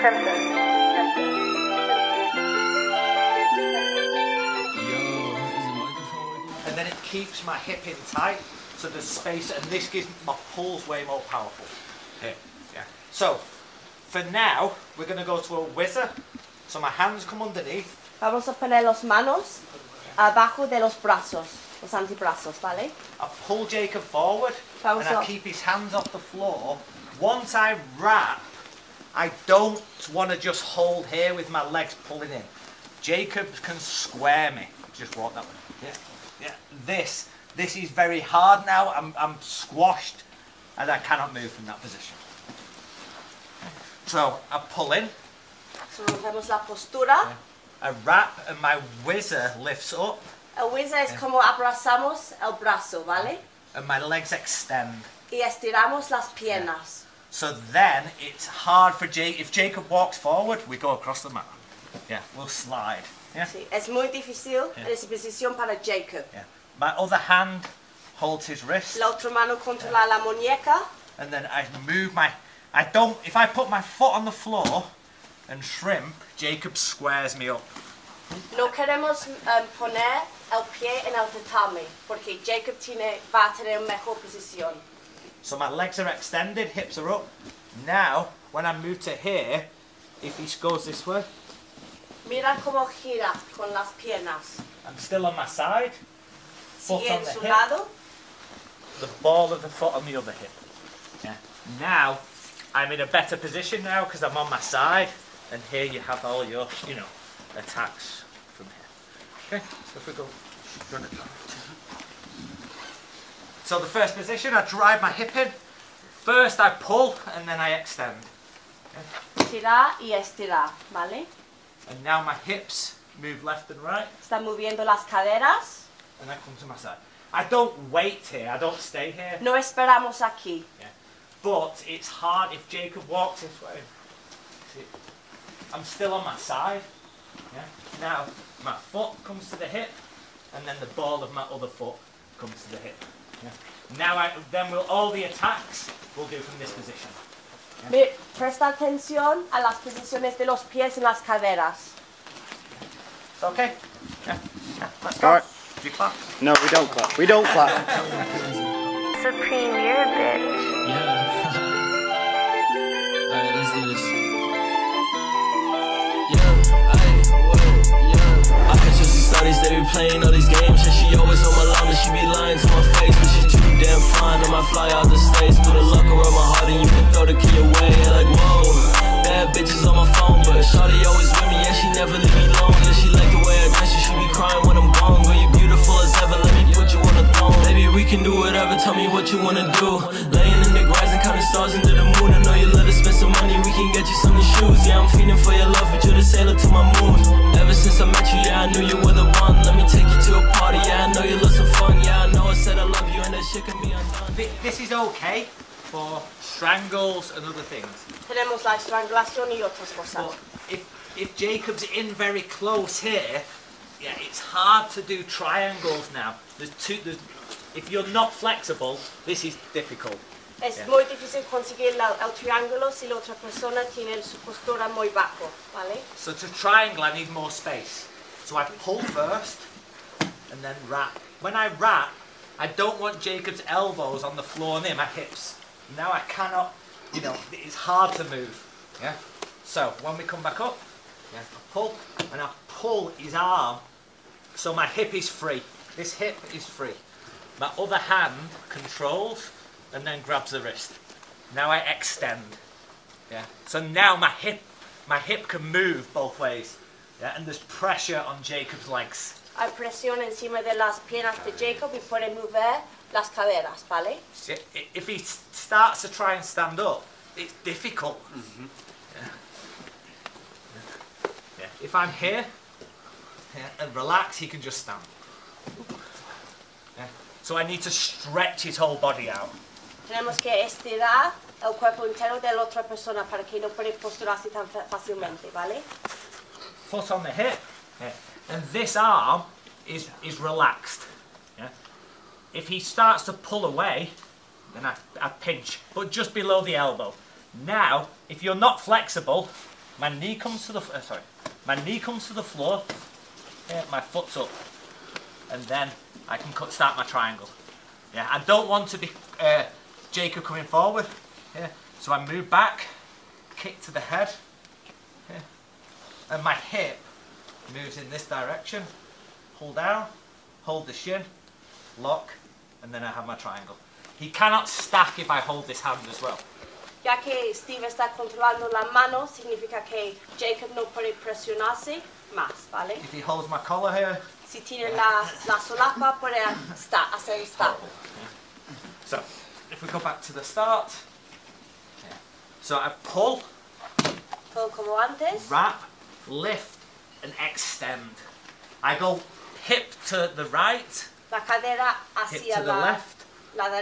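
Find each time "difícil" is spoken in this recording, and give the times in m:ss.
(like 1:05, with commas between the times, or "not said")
1:04, 3:41.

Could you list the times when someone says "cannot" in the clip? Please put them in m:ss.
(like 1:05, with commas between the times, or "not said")
0:40, 3:56, 5:24.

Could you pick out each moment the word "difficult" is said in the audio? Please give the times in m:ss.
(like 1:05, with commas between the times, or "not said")
3:39, 4:27.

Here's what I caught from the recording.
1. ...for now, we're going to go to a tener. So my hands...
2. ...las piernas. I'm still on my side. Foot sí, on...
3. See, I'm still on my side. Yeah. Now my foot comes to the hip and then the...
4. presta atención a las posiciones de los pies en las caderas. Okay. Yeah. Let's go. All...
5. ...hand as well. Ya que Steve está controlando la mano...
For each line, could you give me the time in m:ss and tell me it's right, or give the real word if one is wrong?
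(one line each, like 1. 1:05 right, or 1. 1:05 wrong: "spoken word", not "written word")
1. 0:14 wrong: "whizzer", not "tener"
2. 1:33 right
3. 2:14 right
4. 2:28 right
5. 5:25 right.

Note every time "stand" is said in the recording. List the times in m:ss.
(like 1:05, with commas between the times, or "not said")
4:26, 4:34.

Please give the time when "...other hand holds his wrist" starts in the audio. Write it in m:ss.
1:06.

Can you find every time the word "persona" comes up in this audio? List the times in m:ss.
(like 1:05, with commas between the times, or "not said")
3:43, 4:42.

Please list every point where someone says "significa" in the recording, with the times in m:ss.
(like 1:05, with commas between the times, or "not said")
5:29.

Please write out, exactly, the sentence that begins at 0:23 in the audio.
I pull Jacob forward, Vamos and I keep his hands off the floor.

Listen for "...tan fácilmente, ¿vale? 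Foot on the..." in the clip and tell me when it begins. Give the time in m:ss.
4:44.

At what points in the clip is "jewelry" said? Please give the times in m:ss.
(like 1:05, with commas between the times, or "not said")
not said.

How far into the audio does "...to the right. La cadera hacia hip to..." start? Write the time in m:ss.
5:50.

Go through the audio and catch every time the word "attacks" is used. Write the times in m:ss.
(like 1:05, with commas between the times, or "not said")
1:47, 2:25.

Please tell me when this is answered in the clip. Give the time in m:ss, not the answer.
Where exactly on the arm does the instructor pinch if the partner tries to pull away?
4:56.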